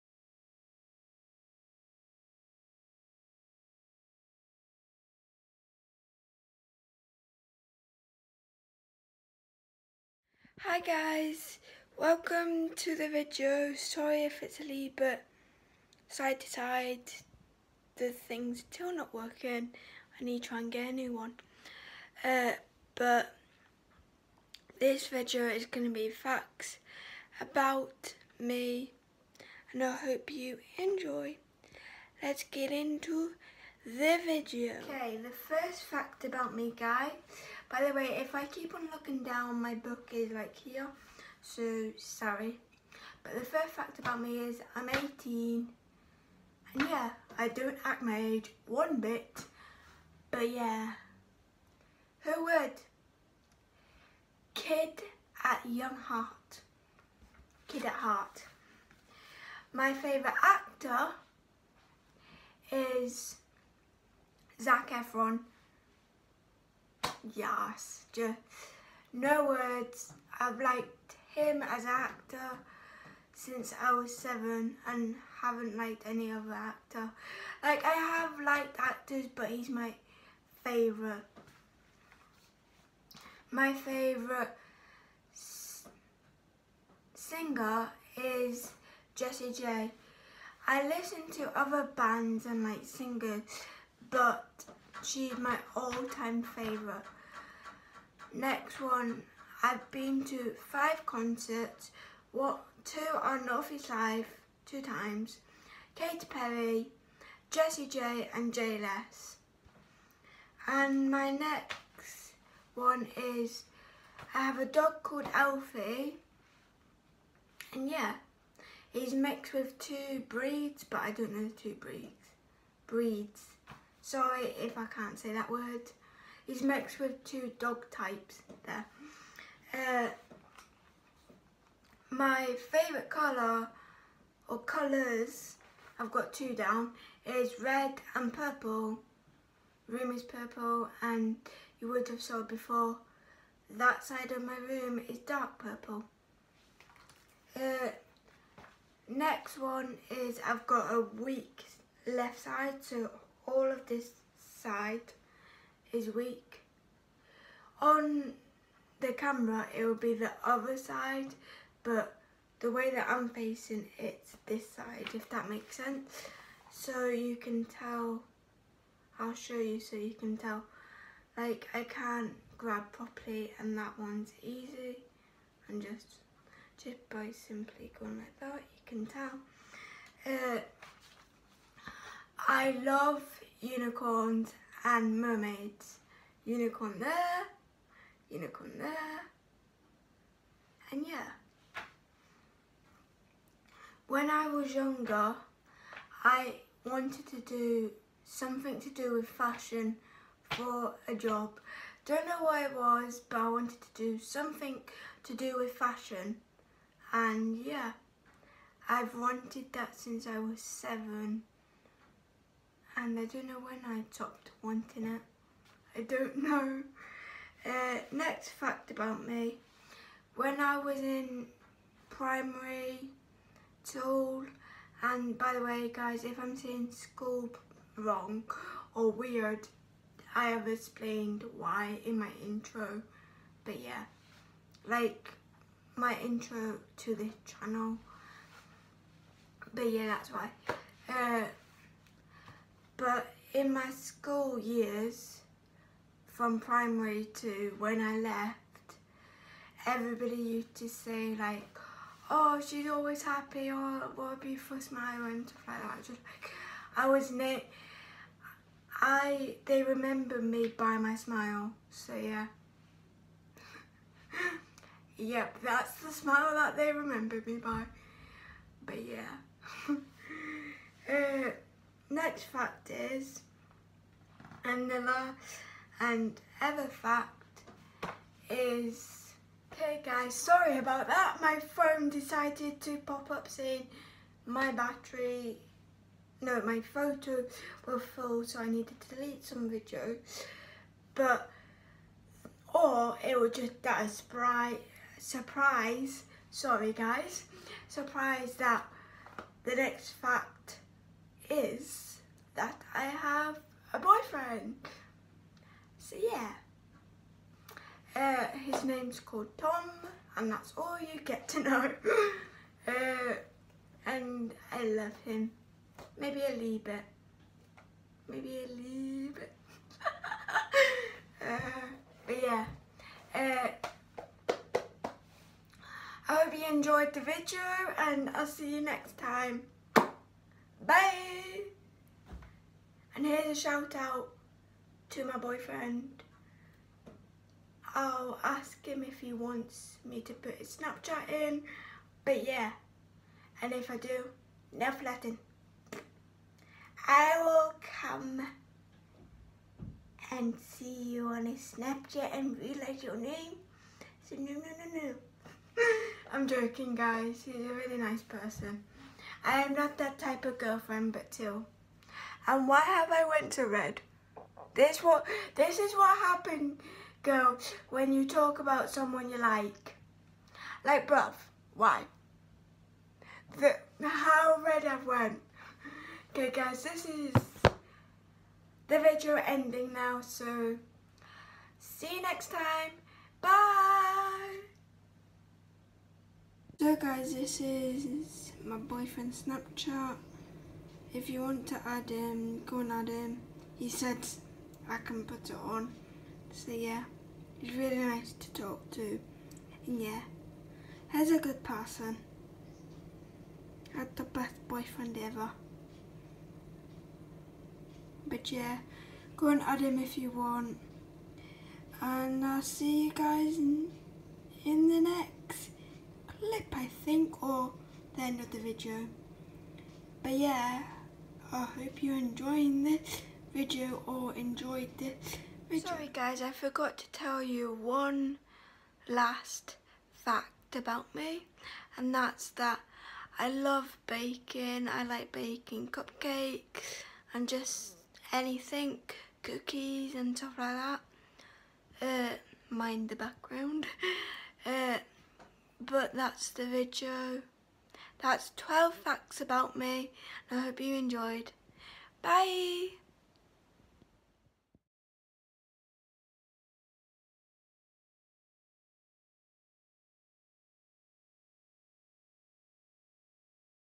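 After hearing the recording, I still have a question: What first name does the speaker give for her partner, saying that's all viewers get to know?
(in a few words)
Tom.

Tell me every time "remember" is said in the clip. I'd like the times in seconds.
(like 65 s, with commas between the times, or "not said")
259 s, 266 s.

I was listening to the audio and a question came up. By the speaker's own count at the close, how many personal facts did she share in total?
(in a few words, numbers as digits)
12.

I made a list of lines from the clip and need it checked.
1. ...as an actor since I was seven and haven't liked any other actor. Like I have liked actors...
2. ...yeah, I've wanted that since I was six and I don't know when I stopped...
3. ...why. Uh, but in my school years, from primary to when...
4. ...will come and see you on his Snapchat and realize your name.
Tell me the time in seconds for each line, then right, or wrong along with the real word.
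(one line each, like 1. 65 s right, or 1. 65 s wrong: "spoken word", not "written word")
1. 71 s right
2. 207 s wrong: "seven", not "six"
3. 240 s right
4. 347 s right.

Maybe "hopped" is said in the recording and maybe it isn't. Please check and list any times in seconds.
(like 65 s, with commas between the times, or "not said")
not said.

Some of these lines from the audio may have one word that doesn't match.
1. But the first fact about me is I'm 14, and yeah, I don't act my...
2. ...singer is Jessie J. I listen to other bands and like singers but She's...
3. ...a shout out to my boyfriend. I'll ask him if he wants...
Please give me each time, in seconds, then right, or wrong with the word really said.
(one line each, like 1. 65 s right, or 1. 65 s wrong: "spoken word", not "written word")
1. 43 s wrong: "18", not "14"
2. 87 s right
3. 333 s right.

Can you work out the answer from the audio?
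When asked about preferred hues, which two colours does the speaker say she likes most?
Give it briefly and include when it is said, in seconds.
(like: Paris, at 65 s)
Red and purple, at 137 s.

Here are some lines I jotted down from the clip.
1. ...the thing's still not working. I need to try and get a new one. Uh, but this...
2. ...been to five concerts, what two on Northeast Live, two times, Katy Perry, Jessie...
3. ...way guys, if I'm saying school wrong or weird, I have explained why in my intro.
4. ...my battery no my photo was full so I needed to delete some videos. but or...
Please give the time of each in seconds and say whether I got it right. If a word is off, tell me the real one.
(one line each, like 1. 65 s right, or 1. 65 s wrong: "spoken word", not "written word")
1. 17 s right
2. 99 s right
3. 225 s right
4. 284 s right.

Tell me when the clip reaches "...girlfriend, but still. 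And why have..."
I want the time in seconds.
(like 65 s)
360 s.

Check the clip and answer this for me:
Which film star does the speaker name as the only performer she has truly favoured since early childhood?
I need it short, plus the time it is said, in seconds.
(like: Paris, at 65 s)
Zac Efron, at 64 s.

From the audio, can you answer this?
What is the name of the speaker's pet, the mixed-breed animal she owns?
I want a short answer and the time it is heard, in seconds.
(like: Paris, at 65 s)
Alfie, at 115 s.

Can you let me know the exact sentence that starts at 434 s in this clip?
I like baking cupcakes and just anything, cookies and stuff like that.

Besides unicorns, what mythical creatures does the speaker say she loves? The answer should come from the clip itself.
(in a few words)
Mermaids.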